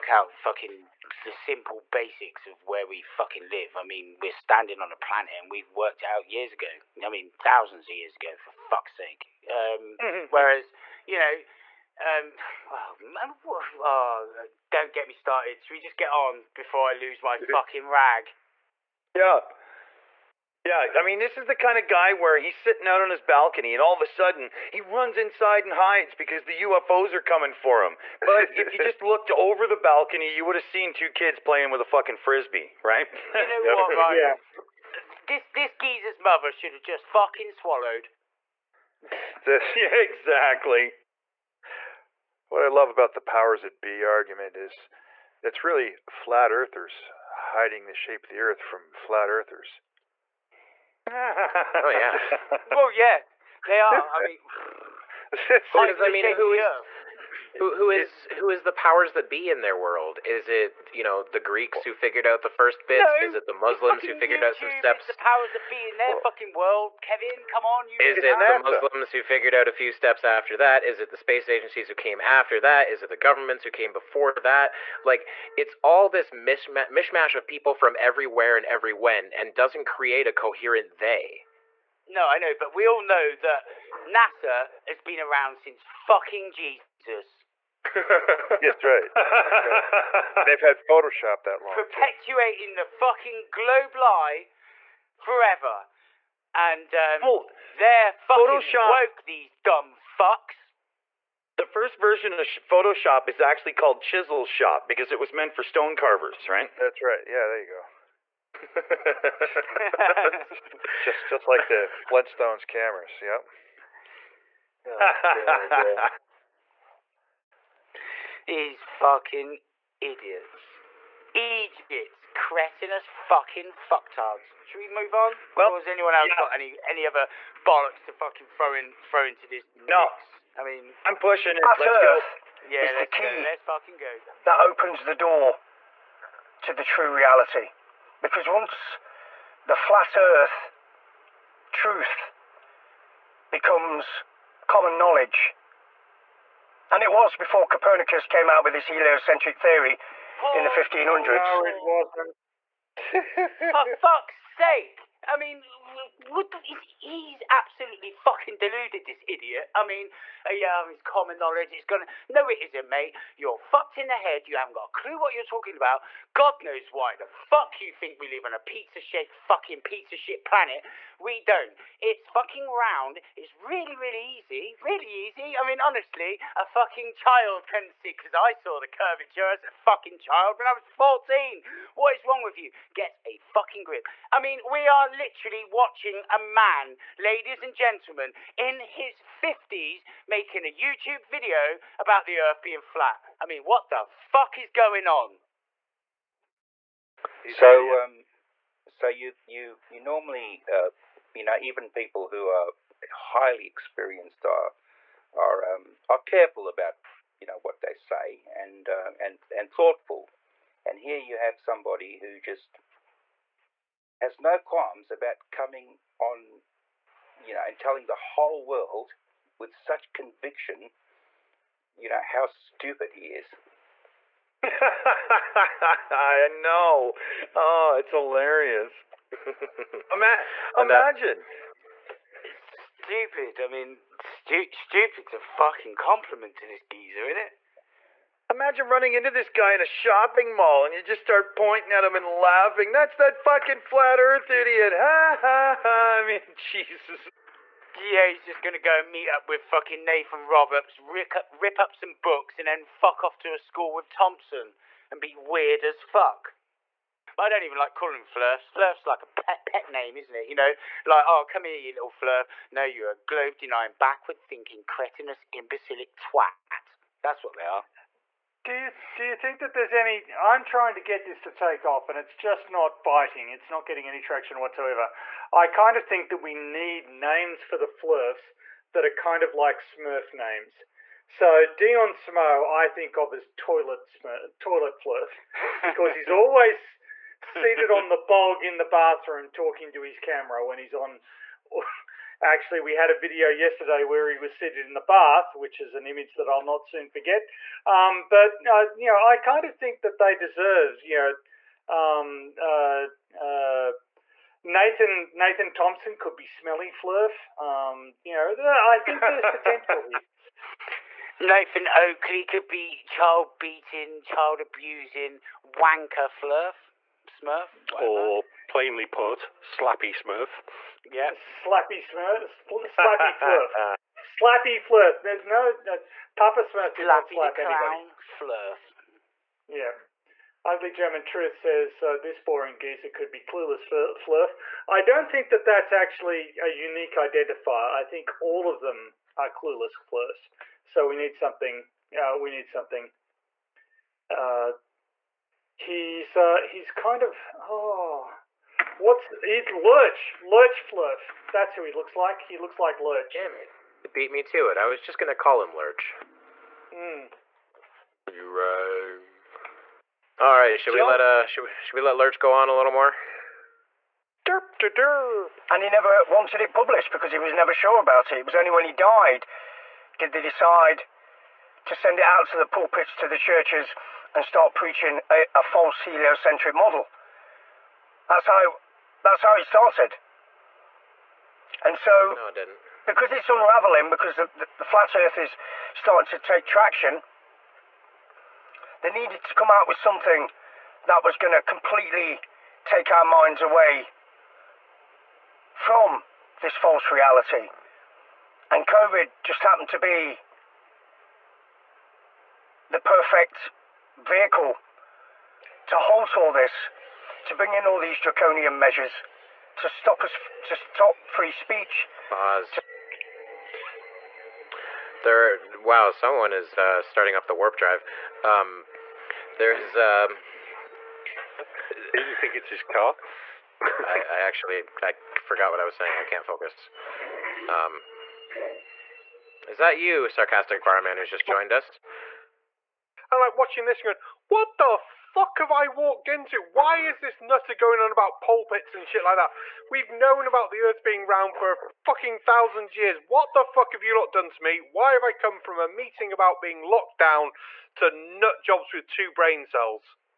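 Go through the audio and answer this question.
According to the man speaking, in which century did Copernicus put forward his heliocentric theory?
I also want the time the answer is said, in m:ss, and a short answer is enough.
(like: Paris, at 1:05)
1500s, at 2:30.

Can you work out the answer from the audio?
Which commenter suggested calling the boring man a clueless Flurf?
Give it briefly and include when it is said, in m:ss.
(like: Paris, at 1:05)
Ugly German Truth, at 5:30.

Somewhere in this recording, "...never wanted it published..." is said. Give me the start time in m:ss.
6:05.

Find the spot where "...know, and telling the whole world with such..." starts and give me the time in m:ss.
3:37.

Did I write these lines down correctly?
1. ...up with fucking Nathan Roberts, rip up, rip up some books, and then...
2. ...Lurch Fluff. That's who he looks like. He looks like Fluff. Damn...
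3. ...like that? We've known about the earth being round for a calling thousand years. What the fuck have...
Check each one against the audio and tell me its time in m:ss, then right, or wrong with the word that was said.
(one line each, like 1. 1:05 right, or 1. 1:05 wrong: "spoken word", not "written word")
1. 4:09 right
2. 5:50 wrong: "Lurch", not "Fluff"
3. 7:19 wrong: "fucking", not "calling".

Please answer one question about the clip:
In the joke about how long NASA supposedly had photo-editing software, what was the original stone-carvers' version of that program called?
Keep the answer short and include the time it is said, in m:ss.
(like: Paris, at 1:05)
Chisel Shop, at 1:44.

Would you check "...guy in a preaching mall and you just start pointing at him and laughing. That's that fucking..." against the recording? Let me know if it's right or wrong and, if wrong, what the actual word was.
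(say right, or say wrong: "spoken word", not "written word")
wrong: "shopping", not "preaching".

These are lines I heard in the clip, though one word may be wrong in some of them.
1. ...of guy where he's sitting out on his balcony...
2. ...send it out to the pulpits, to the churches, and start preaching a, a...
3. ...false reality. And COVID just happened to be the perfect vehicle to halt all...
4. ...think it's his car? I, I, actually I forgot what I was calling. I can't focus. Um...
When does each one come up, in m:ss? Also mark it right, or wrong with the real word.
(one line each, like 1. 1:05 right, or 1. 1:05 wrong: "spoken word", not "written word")
1. 0:21 right
2. 6:11 right
3. 6:36 right
4. 7:02 wrong: "saying", not "calling".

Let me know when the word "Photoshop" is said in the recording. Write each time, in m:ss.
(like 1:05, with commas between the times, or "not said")
1:30, 1:38, 1:42.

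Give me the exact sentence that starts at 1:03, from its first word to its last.
No, is it the Muslims who figured YouTube out some steps?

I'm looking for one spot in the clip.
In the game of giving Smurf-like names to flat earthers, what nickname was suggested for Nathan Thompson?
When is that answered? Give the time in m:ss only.
5:06.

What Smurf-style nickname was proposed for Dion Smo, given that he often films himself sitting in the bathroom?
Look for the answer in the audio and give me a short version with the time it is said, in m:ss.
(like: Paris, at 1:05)
Toilet Flurf, at 4:44.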